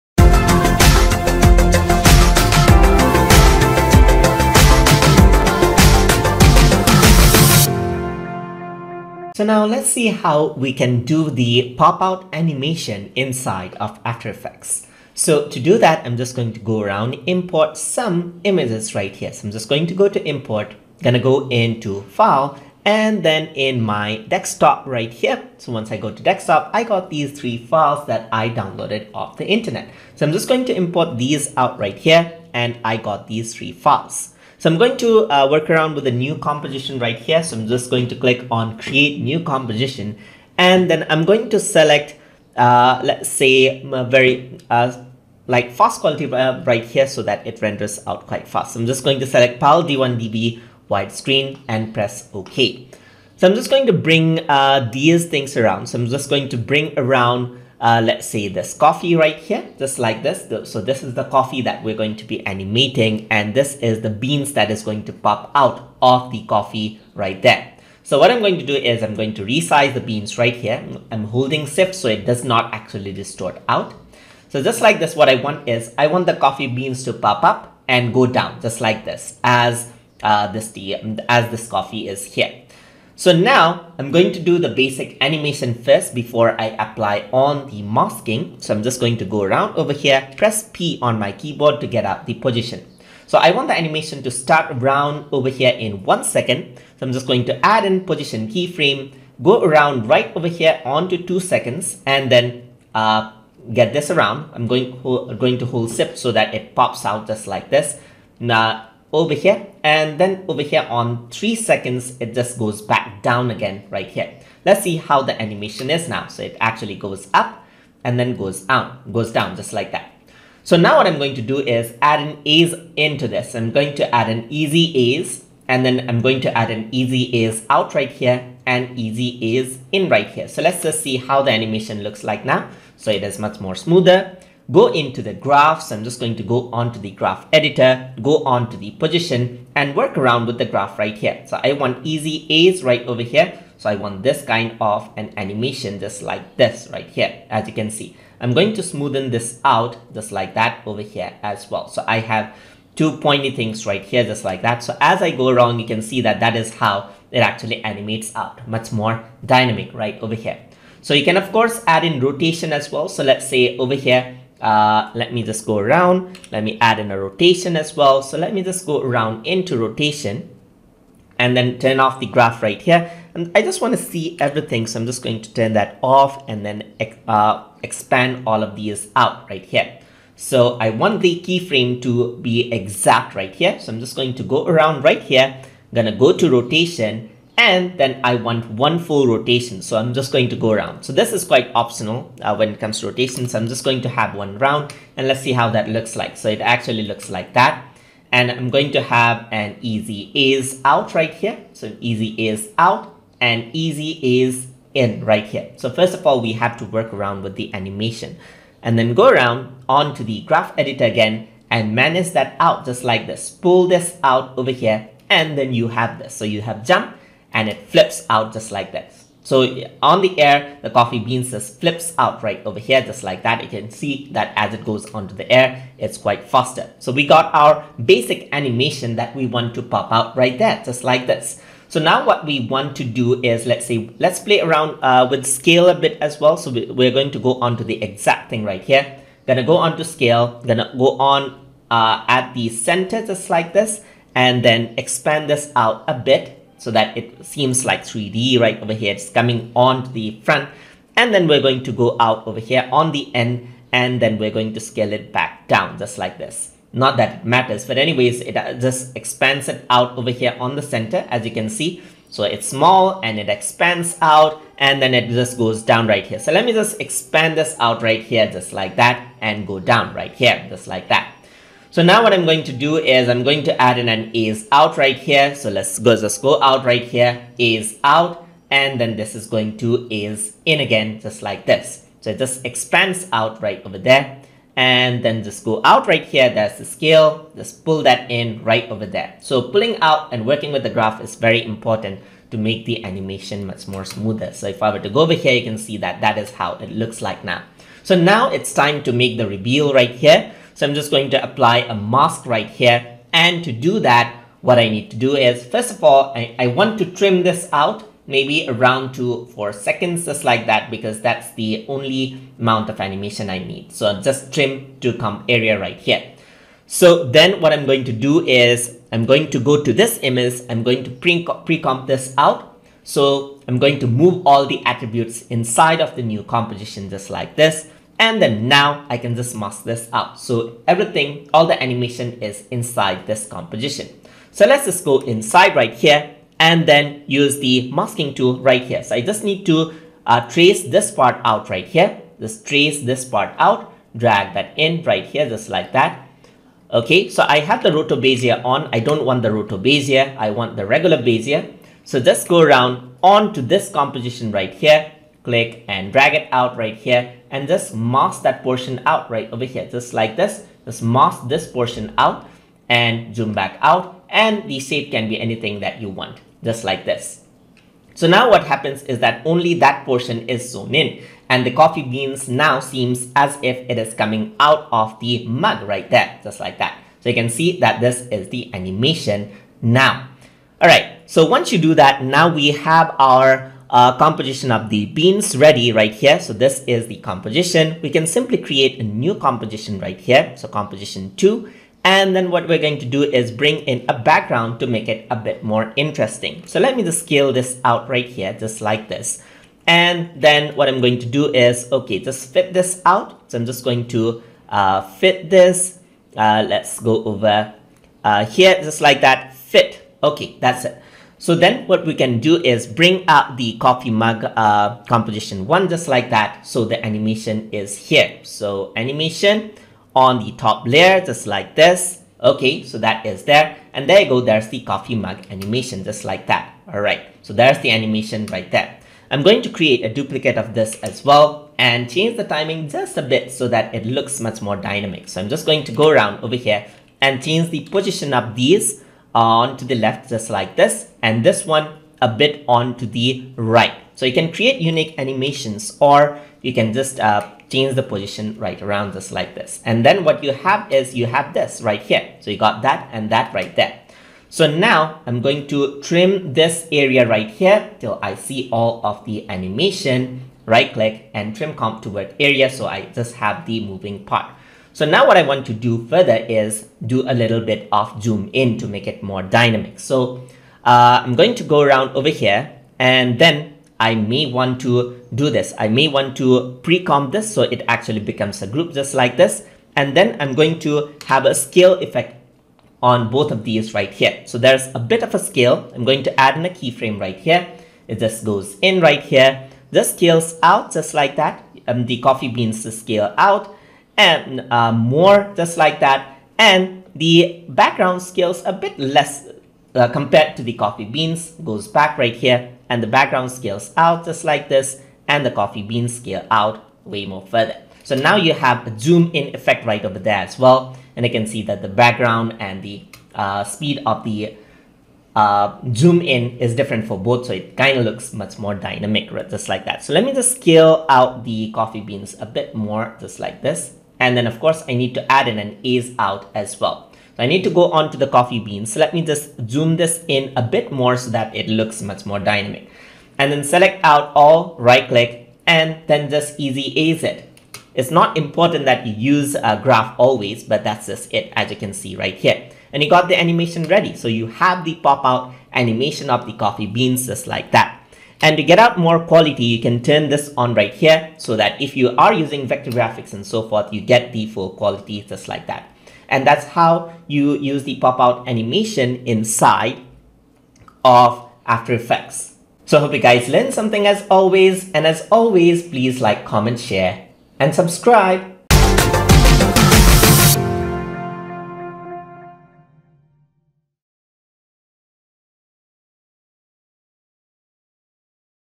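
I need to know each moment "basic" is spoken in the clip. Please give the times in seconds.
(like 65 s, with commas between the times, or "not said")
84 s, 228 s.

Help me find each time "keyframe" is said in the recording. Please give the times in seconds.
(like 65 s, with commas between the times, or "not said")
98 s, 181 s, 486 s.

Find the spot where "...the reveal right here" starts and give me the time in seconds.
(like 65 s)
299 s.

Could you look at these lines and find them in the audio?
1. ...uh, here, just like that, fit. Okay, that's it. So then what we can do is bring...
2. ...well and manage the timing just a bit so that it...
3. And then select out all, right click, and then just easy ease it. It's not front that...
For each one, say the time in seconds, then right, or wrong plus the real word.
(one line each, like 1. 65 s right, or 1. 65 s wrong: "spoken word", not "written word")
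1. 408 s right
2. 431 s wrong: "change", not "manage"
3. 533 s wrong: "important", not "front".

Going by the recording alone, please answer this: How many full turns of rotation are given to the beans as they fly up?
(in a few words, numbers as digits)
1.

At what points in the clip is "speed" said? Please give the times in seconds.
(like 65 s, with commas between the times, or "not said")
513 s.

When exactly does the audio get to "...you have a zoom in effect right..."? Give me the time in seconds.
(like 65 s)
508 s.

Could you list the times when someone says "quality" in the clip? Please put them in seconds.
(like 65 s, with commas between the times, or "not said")
46 s, 549 s, 554 s.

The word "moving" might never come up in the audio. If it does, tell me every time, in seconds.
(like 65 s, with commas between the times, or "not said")
463 s.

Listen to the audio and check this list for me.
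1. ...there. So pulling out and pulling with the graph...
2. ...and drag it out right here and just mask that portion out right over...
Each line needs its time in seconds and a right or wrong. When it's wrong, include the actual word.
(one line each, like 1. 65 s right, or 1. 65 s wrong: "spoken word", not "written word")
1. 289 s wrong: "working", not "pulling"
2. 355 s right.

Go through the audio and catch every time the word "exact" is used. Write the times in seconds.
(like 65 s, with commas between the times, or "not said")
182 s, 238 s.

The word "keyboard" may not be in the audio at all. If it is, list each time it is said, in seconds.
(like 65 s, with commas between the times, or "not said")
91 s.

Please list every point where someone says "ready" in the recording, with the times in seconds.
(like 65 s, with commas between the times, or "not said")
385 s, 543 s.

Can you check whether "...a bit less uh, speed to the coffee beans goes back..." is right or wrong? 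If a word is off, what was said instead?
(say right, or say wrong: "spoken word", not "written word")
wrong: "compared", not "speed".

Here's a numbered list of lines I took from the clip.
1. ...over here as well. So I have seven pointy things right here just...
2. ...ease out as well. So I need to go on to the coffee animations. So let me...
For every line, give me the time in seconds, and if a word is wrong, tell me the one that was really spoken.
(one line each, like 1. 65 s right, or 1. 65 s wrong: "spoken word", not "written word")
1. 150 s wrong: "two", not "seven"
2. 525 s wrong: "beans", not "animations".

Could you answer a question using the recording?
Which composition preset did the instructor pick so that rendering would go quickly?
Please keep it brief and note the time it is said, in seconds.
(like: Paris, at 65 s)
PAL D1DV widescreen, at 49 s.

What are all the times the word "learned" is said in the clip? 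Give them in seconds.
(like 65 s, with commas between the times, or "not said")
563 s.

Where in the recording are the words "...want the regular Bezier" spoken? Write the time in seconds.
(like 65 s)
350 s.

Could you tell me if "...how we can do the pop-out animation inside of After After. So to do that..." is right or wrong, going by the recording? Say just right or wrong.
wrong.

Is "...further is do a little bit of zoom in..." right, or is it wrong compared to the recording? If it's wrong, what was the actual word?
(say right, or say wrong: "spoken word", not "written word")
right.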